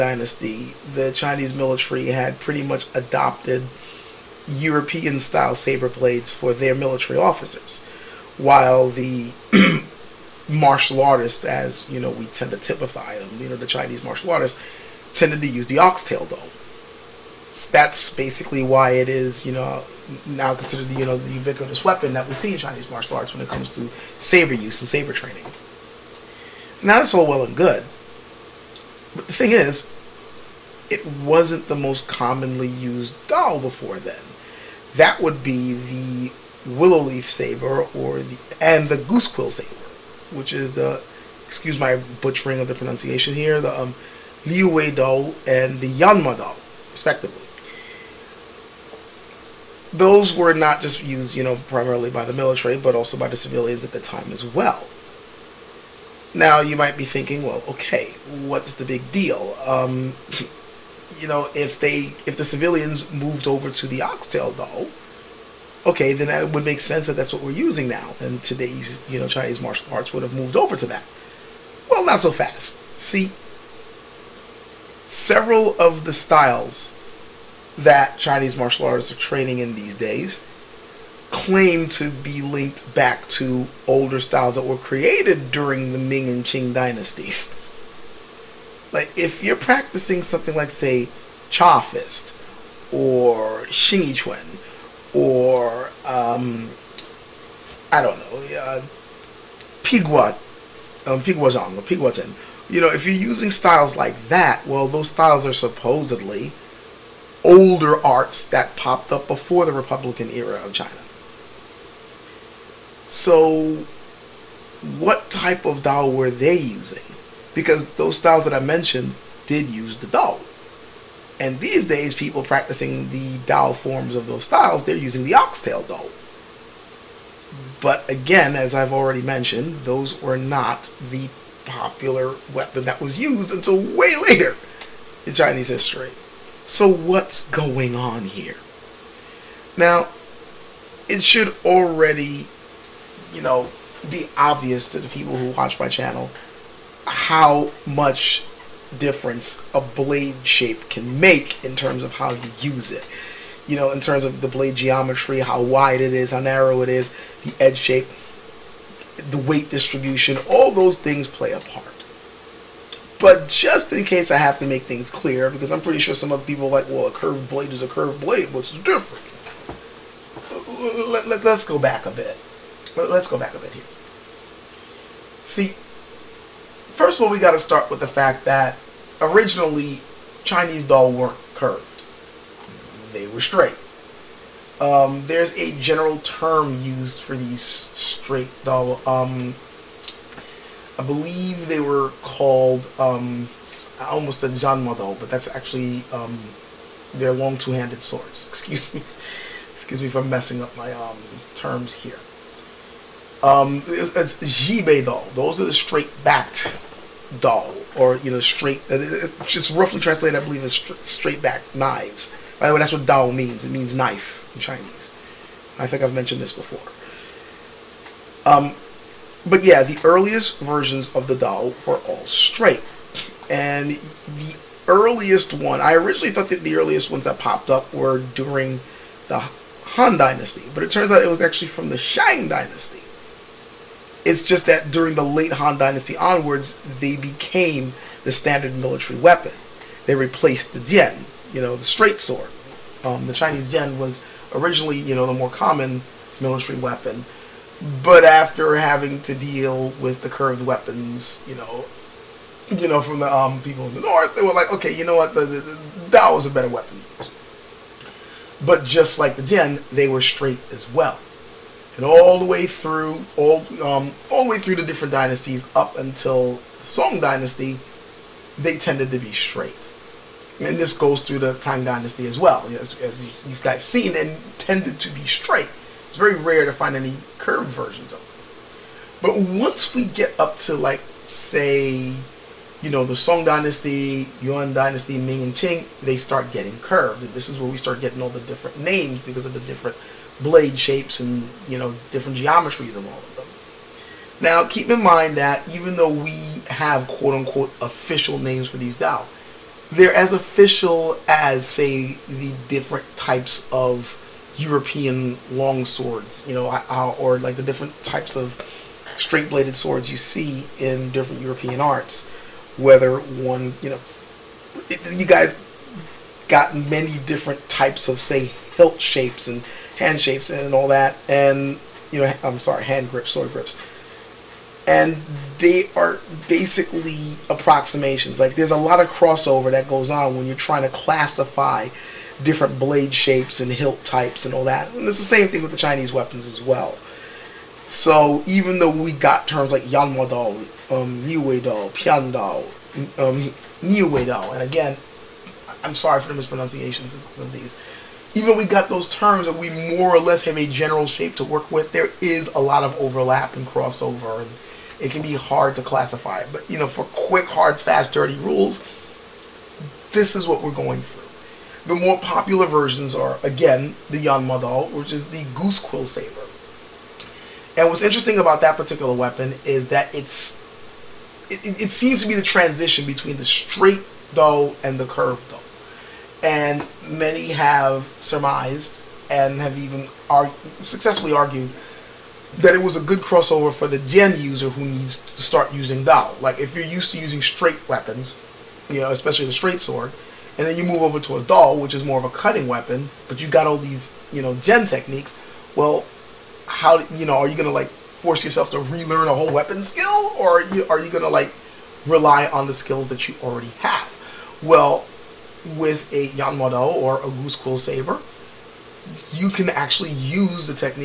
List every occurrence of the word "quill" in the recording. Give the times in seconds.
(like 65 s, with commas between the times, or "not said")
39 s, 365 s, 407 s.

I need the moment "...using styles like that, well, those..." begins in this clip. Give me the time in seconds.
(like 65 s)
103 s.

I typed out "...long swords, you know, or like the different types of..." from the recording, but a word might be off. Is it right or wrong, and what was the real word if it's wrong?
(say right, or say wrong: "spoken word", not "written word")
right.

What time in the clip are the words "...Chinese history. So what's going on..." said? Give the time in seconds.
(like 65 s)
135 s.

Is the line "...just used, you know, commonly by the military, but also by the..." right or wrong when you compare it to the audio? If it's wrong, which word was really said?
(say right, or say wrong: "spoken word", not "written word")
wrong: "primarily", not "commonly".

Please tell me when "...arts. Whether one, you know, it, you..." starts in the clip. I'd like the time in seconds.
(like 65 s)
311 s.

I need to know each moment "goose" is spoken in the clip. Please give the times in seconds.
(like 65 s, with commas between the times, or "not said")
38 s, 365 s, 407 s.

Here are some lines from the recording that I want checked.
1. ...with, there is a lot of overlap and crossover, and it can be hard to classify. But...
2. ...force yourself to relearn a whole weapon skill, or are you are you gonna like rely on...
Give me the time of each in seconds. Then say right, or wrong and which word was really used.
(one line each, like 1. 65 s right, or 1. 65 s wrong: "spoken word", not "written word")
1. 351 s right
2. 397 s right.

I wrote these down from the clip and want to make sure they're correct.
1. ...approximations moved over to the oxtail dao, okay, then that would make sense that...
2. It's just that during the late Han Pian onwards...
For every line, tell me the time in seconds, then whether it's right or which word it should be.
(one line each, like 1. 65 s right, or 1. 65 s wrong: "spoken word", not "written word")
1. 62 s wrong: "civilians", not "approximations"
2. 234 s wrong: "Dynasty", not "Pian".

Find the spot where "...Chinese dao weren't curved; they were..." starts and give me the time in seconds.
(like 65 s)
180 s.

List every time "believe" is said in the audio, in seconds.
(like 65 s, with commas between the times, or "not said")
191 s, 210 s.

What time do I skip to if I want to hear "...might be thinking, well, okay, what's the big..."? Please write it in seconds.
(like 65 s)
56 s.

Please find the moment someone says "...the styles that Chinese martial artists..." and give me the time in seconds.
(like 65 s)
76 s.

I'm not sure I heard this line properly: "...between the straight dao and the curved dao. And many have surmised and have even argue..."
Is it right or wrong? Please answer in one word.
right.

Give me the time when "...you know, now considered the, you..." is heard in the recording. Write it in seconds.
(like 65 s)
19 s.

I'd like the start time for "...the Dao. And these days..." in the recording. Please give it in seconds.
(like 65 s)
119 s.